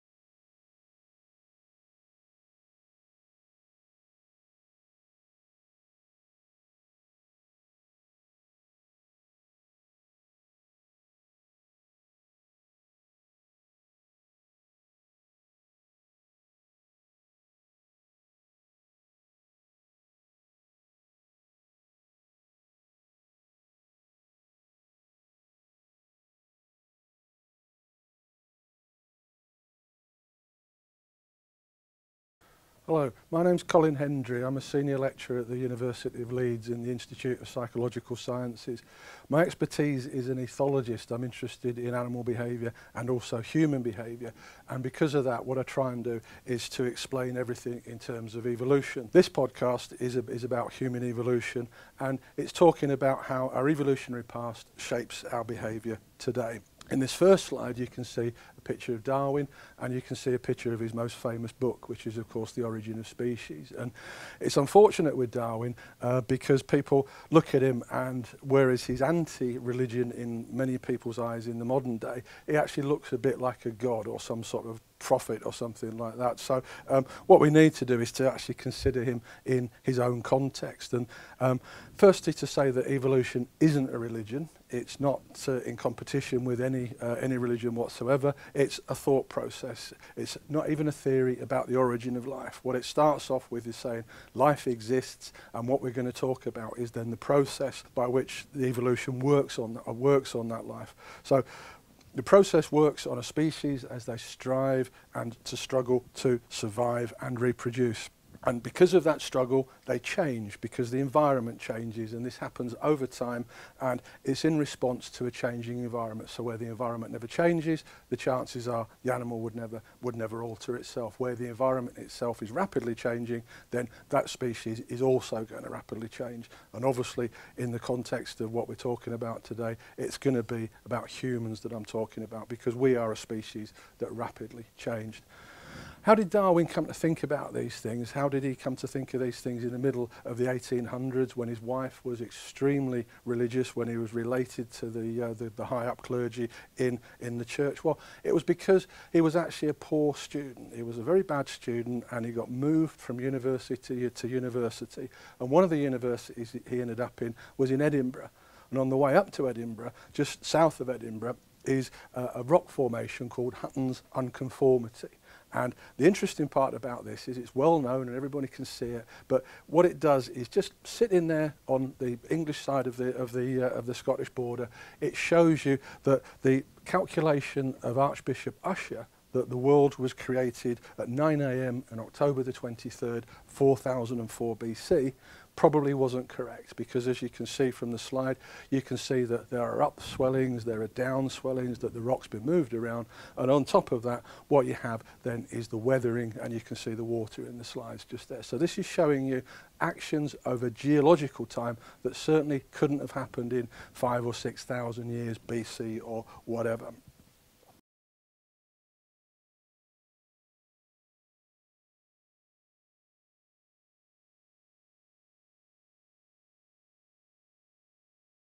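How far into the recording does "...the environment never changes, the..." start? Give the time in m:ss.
1:56.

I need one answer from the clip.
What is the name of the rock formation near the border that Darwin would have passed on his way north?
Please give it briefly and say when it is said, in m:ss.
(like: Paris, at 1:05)
Hutton's Unconformity, at 2:43.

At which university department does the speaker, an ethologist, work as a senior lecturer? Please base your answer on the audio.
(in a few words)
Institute of Psychological Sciences.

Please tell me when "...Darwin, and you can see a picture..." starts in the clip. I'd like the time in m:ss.
0:59.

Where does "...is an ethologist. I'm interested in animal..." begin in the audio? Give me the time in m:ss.
0:40.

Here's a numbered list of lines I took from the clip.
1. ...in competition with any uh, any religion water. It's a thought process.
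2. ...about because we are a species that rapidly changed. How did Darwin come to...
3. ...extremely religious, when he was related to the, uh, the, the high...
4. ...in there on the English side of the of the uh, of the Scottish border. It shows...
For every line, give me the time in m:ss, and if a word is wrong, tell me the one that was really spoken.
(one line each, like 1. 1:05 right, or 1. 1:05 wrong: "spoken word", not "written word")
1. 1:25 wrong: "whatsoever", not "water"
2. 2:12 right
3. 2:22 right
4. 2:51 right.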